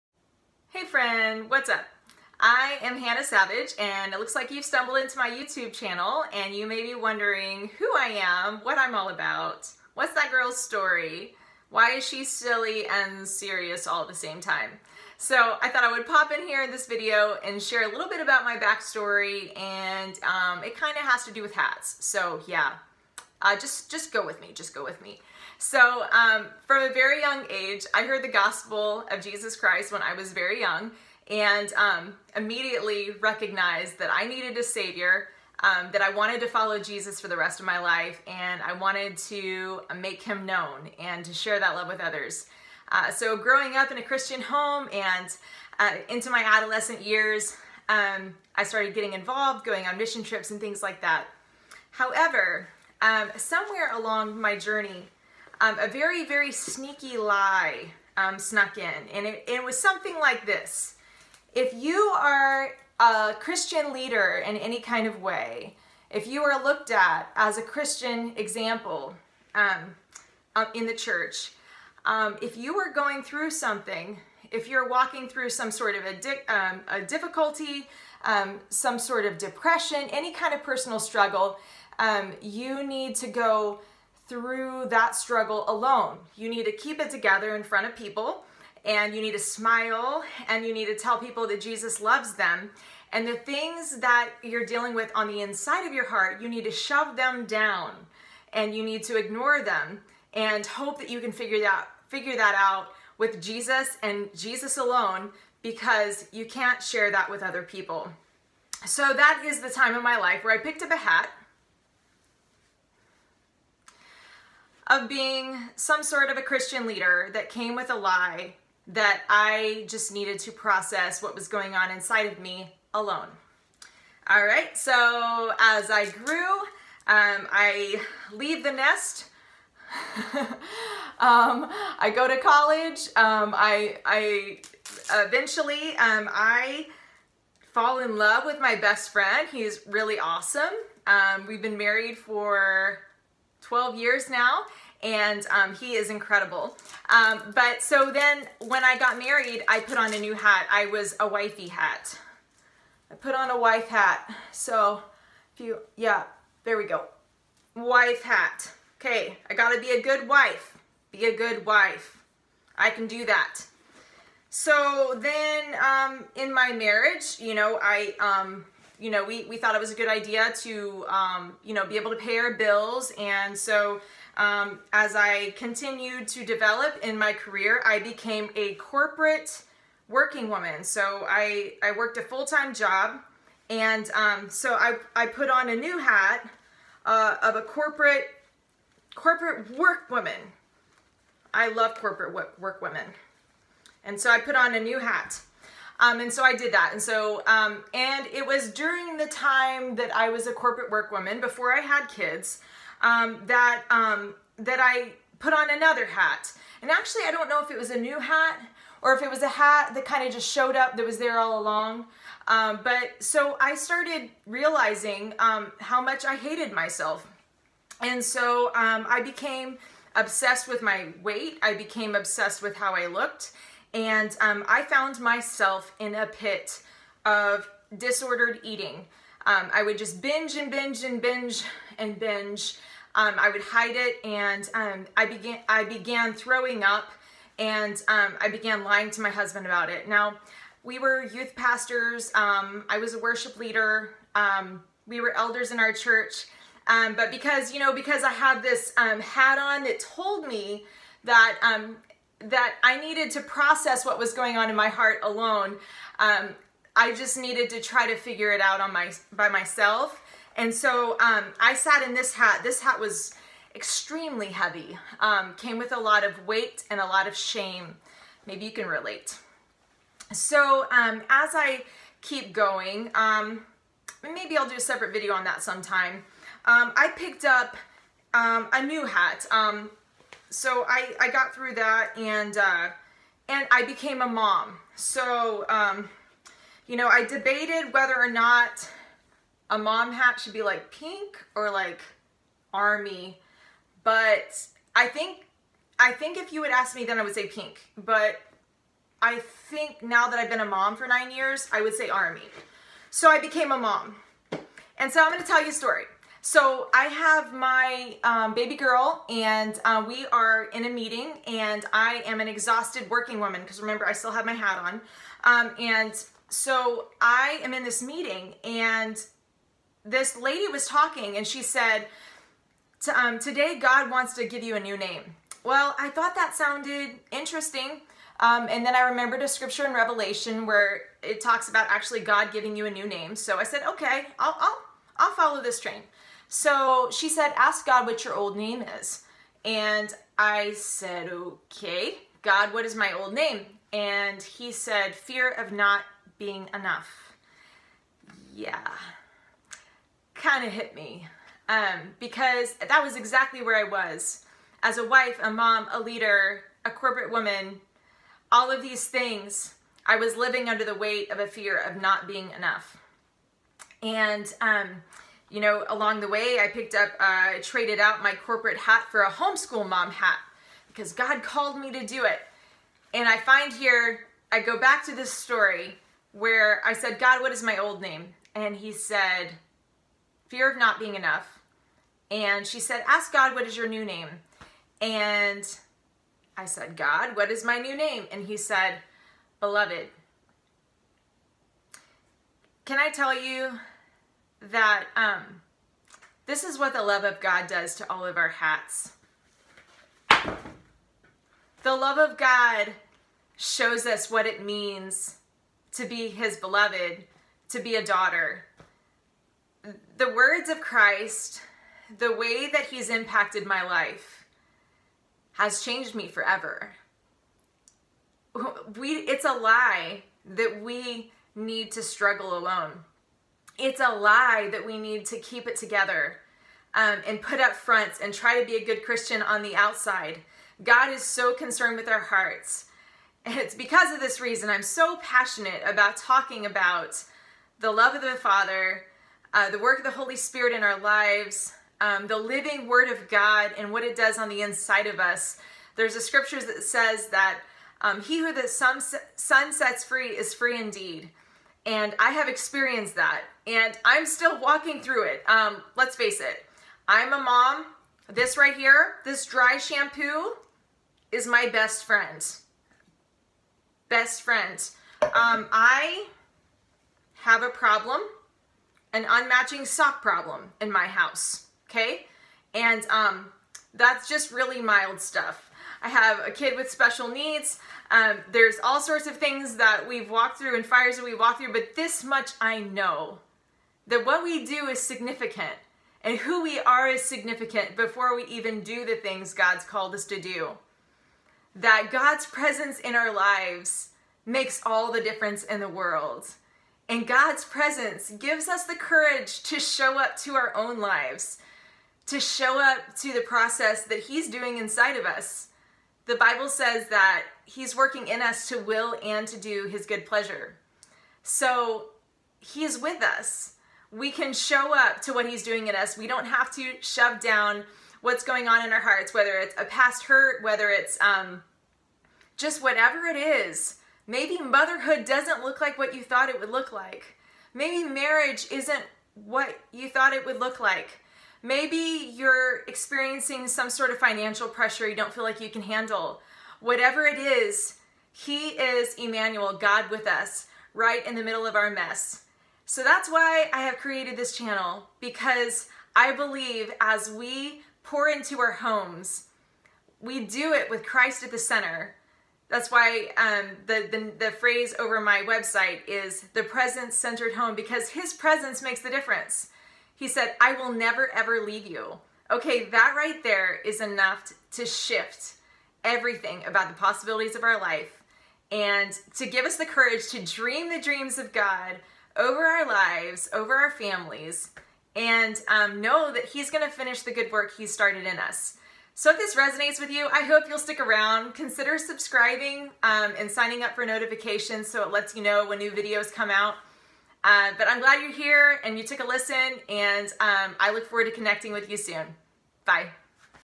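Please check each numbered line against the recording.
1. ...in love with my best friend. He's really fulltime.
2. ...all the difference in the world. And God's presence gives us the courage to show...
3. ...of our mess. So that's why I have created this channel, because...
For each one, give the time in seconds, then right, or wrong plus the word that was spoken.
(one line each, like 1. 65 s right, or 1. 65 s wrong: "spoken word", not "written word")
1. 137 s wrong: "awesome", not "fulltime"
2. 494 s right
3. 541 s right.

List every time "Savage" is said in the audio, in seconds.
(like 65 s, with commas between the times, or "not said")
3 s.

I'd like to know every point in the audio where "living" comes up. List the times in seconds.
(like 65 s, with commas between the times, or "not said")
360 s, 442 s.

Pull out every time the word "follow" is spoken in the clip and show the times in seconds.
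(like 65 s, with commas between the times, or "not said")
36 s, 335 s.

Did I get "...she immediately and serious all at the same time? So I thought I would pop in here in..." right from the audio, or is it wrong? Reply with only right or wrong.
wrong.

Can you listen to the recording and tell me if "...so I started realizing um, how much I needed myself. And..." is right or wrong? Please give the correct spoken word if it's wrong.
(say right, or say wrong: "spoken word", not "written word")
wrong: "hated", not "needed".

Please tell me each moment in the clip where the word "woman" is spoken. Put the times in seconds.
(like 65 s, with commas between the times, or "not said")
180 s, 190 s, 201 s, 313 s, 357 s.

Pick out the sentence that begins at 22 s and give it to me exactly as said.
So yeah, uh, just, just go with me, just go with me.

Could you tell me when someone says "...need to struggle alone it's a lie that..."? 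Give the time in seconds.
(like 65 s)
421 s.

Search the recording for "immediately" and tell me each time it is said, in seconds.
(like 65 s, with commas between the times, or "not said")
32 s.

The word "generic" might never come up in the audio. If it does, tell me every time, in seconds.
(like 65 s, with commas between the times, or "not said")
not said.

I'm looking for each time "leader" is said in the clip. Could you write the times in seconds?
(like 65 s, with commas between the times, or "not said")
63 s, 116 s, 243 s, 355 s.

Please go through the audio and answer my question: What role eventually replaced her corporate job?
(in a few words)
Homeschool mom.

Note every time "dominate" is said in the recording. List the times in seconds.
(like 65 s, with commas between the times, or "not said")
not said.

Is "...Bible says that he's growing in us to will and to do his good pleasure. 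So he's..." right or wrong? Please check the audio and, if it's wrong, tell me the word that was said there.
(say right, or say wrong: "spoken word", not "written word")
wrong: "working", not "growing".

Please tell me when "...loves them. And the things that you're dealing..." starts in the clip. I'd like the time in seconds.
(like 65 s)
92 s.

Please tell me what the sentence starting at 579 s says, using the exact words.
So if this resonates with you, I hope you'll stick around.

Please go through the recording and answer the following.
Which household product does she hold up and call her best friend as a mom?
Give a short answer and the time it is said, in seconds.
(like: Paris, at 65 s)
Dry shampoo, at 459 s.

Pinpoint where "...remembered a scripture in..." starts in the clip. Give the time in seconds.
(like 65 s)
329 s.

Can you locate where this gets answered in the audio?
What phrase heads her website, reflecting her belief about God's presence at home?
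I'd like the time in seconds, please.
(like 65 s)
556 s.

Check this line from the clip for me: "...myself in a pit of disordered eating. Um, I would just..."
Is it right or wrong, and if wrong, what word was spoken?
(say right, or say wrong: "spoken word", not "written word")
right.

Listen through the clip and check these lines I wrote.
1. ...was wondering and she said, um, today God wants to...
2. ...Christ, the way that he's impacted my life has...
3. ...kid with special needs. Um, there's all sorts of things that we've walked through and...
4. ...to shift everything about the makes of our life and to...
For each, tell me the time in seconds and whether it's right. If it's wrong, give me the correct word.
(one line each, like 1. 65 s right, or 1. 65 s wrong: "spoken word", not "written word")
1. 320 s wrong: "talking", not "wondering"
2. 410 s right
3. 476 s right
4. 564 s wrong: "possibilities", not "makes".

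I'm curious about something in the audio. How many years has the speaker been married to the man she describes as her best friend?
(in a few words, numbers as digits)
12.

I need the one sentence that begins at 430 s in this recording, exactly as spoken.
God is so concerned with our hearts.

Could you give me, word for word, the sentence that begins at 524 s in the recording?
Maybe motherhood doesn't look like what you thought it would look like.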